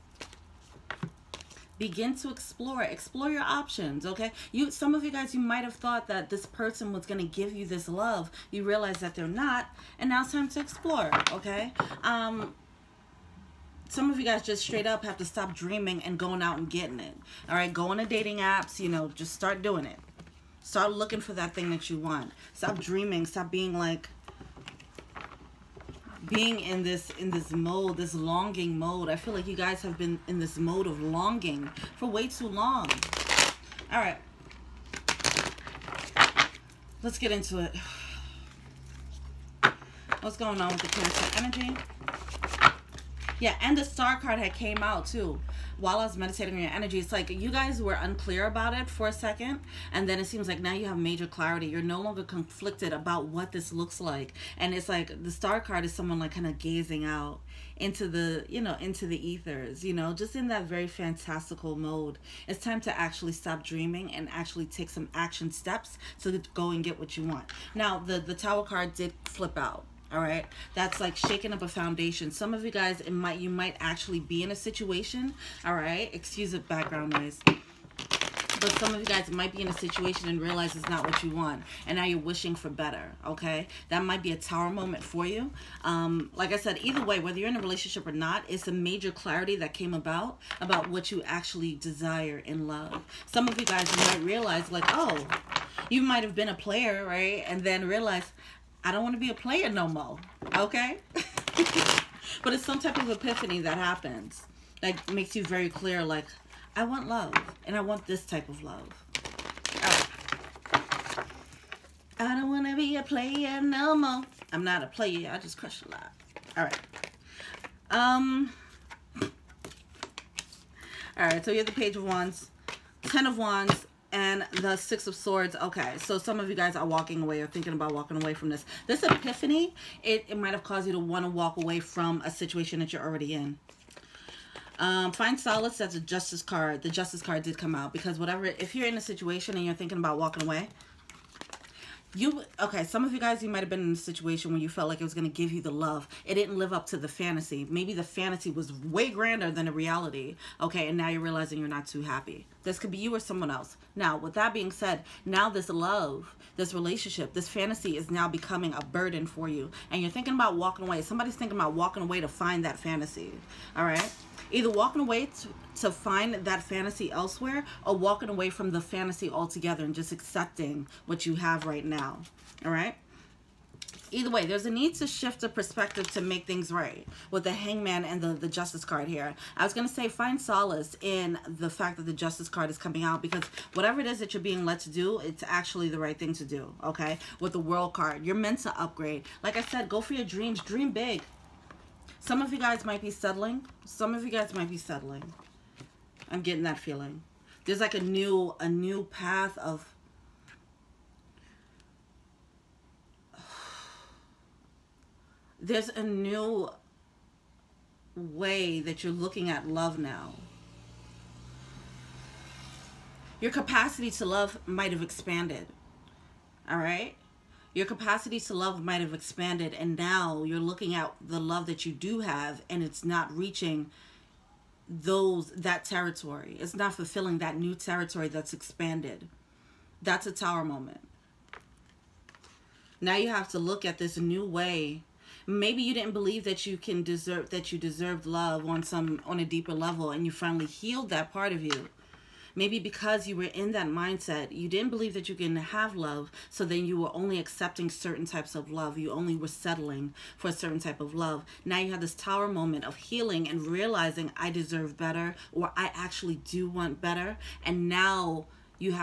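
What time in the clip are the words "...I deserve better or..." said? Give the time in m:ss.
4:14.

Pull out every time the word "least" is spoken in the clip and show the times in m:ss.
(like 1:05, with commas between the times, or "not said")
not said.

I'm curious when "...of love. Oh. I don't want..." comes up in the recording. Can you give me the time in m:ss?
1:48.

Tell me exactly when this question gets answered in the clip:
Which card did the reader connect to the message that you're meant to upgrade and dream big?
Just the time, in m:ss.
3:07.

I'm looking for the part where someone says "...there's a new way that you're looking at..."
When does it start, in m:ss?
3:25.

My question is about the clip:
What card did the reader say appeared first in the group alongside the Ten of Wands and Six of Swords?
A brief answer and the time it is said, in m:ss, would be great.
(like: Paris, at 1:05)
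Page of Wands, at 2:01.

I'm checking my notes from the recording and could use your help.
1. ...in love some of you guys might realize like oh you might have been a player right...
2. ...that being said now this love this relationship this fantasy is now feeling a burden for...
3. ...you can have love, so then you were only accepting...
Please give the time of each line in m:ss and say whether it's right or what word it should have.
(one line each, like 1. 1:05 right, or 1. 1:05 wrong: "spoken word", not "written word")
1. 1:32 right
2. 2:34 wrong: "becoming", not "feeling"
3. 4:05 right.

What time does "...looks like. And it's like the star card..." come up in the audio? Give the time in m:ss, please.
0:53.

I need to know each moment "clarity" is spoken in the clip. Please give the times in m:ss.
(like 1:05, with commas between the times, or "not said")
0:51, 1:29.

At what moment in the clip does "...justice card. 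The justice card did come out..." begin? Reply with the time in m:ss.
2:15.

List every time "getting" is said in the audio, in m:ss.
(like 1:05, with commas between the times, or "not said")
0:16, 3:16.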